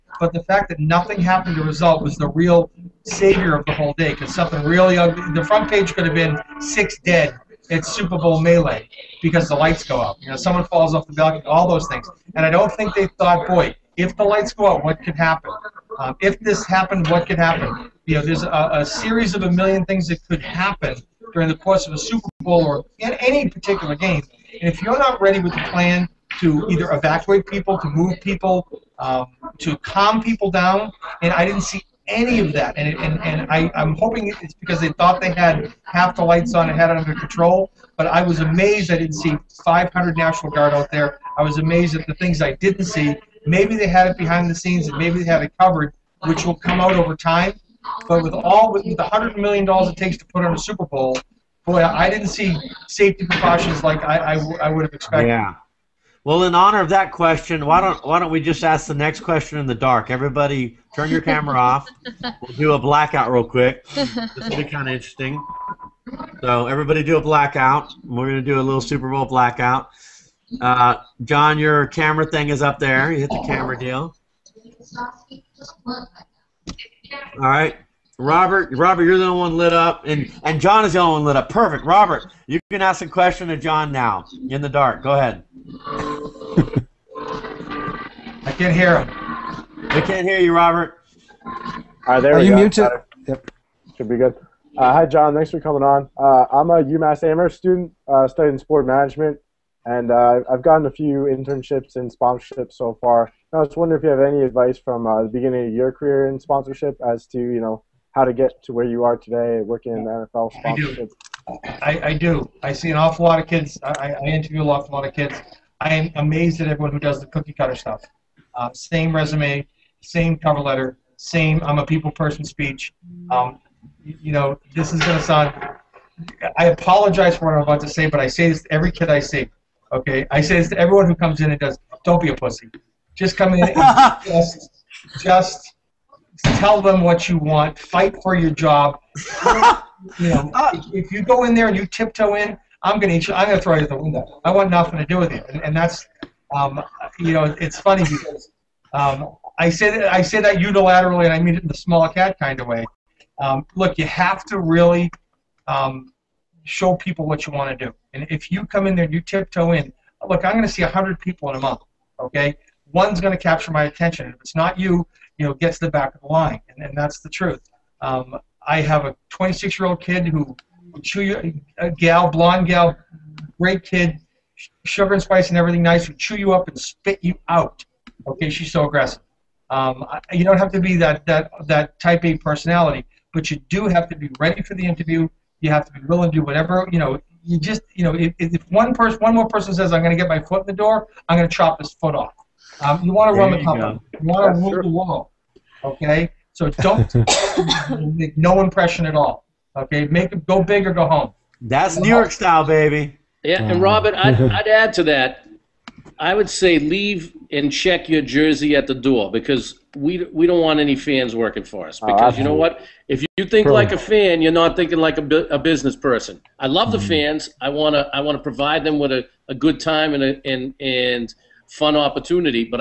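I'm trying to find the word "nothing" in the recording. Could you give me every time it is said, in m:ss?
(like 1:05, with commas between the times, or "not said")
0:00, 2:24.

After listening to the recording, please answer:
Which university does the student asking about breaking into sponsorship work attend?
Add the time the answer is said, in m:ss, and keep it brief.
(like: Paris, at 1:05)
UMass Amherst, at 1:36.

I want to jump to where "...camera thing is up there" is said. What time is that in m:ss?
1:11.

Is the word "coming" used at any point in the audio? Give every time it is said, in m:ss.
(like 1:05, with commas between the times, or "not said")
1:35.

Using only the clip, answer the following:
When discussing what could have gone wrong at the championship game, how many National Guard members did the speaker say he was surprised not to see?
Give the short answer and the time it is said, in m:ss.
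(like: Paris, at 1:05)
500, at 0:39.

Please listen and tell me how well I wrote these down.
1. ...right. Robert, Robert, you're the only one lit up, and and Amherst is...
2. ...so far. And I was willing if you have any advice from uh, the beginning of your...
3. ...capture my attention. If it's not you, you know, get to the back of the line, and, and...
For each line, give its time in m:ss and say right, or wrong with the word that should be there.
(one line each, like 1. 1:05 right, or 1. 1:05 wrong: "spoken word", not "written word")
1. 1:17 wrong: "John", not "Amherst"
2. 1:42 wrong: "wondering", not "willing"
3. 2:43 right.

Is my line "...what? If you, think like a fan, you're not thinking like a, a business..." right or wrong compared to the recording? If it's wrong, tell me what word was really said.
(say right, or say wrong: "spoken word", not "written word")
right.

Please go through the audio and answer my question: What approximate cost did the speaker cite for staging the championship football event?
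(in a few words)
$100 million.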